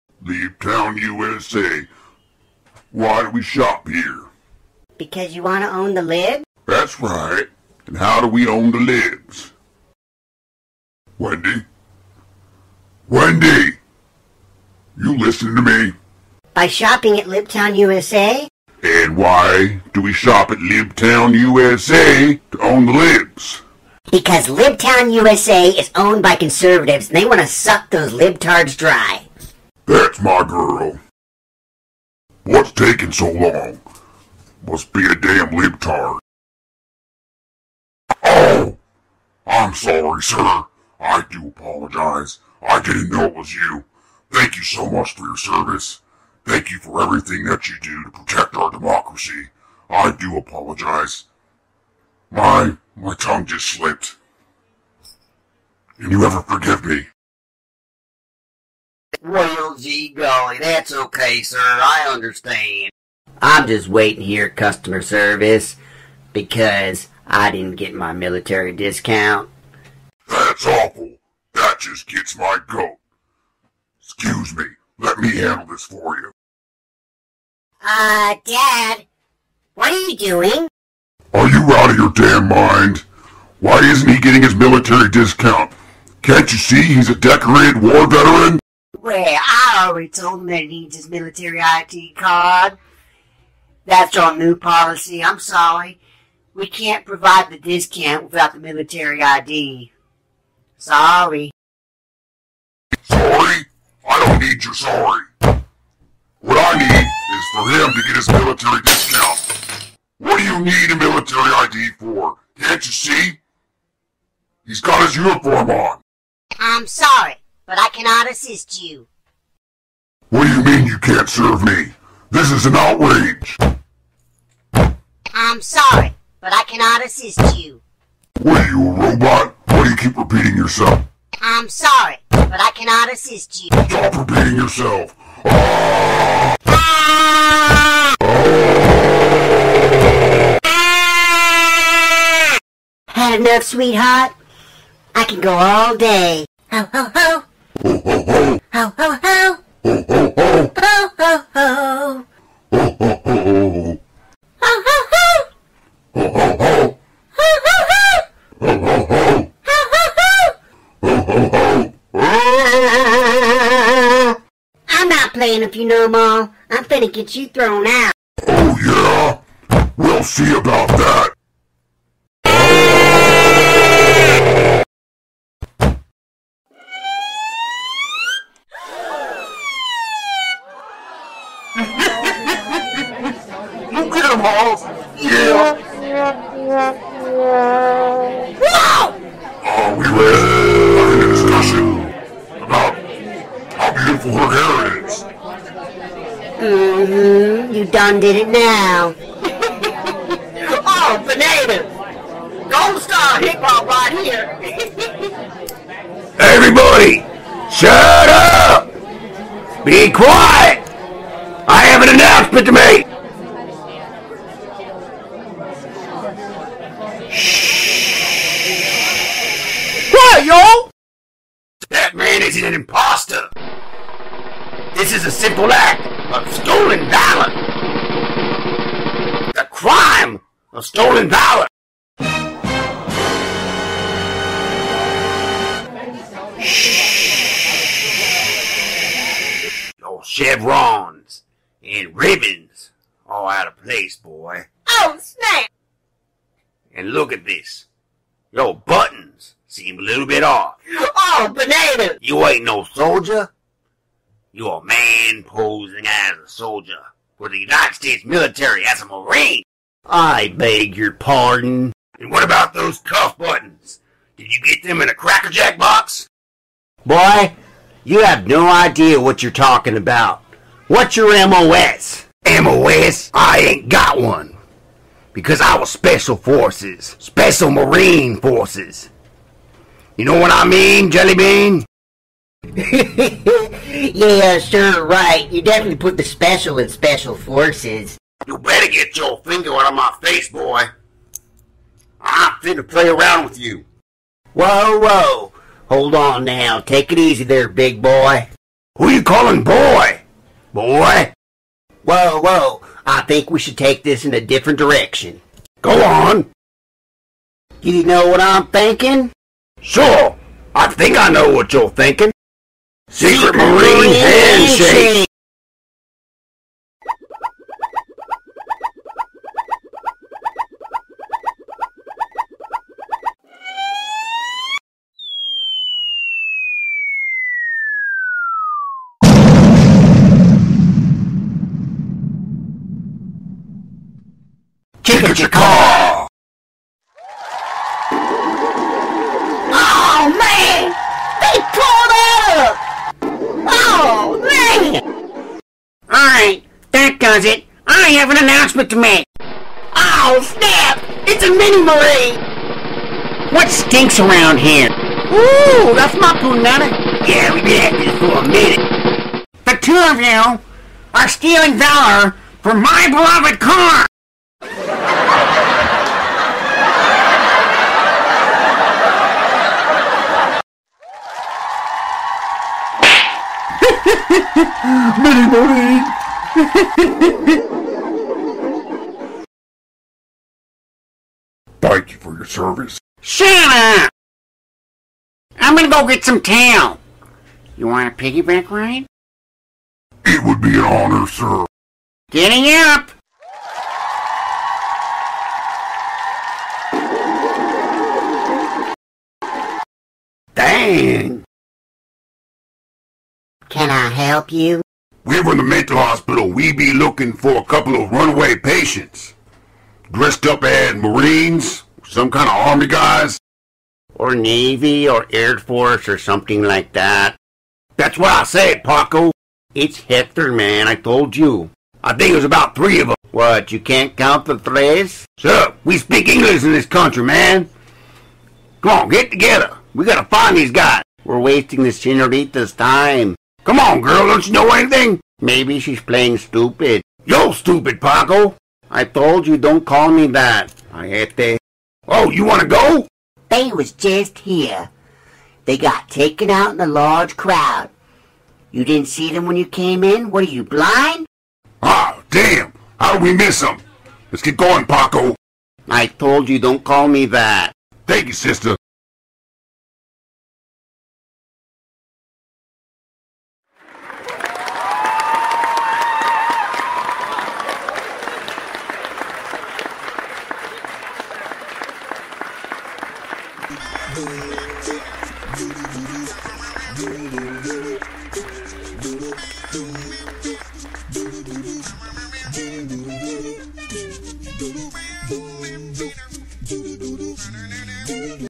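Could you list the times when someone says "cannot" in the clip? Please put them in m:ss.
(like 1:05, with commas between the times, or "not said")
1:57, 2:06, 2:12.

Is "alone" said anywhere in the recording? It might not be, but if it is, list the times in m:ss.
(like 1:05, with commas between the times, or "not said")
not said.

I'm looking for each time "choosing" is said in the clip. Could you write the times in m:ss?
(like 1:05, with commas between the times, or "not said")
not said.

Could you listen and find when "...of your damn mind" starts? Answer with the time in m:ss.
1:21.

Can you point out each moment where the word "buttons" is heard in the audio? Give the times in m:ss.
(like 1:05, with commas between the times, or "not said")
4:08, 4:23.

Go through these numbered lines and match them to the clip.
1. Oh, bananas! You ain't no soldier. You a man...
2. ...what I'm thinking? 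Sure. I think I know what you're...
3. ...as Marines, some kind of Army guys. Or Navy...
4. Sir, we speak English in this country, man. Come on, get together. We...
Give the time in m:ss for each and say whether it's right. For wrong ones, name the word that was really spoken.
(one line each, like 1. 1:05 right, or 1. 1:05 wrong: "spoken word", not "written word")
1. 4:10 right
2. 5:08 right
3. 6:50 right
4. 7:05 right.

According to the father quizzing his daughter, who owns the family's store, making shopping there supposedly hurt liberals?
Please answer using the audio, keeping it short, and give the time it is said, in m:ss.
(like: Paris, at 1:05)
conservatives, at 0:25.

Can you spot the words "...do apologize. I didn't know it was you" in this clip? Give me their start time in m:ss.
0:41.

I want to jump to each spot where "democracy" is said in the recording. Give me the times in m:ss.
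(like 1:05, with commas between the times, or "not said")
0:48.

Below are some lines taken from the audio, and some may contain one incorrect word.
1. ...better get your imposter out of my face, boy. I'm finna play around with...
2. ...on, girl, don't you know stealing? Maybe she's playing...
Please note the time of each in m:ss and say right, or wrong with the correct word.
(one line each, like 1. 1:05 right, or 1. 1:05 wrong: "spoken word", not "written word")
1. 4:48 wrong: "finger", not "imposter"
2. 7:13 wrong: "anything", not "stealing".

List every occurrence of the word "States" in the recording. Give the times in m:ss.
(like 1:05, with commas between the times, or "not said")
4:17.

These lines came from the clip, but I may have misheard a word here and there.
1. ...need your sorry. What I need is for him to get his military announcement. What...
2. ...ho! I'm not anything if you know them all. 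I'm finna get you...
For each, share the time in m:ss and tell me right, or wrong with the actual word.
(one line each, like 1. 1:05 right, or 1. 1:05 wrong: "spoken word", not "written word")
1. 1:44 wrong: "discount", not "announcement"
2. 2:42 wrong: "playing", not "anything".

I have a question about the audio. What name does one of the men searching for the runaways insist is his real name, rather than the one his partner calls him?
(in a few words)
Hector.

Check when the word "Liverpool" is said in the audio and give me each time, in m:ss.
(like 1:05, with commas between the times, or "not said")
not said.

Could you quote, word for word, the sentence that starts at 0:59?
Well, gee golly, that's okay, sir.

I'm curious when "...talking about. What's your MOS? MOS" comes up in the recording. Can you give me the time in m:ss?
4:29.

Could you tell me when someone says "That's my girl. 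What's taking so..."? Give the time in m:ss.
0:30.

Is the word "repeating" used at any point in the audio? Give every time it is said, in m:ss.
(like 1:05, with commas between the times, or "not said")
2:10, 2:14.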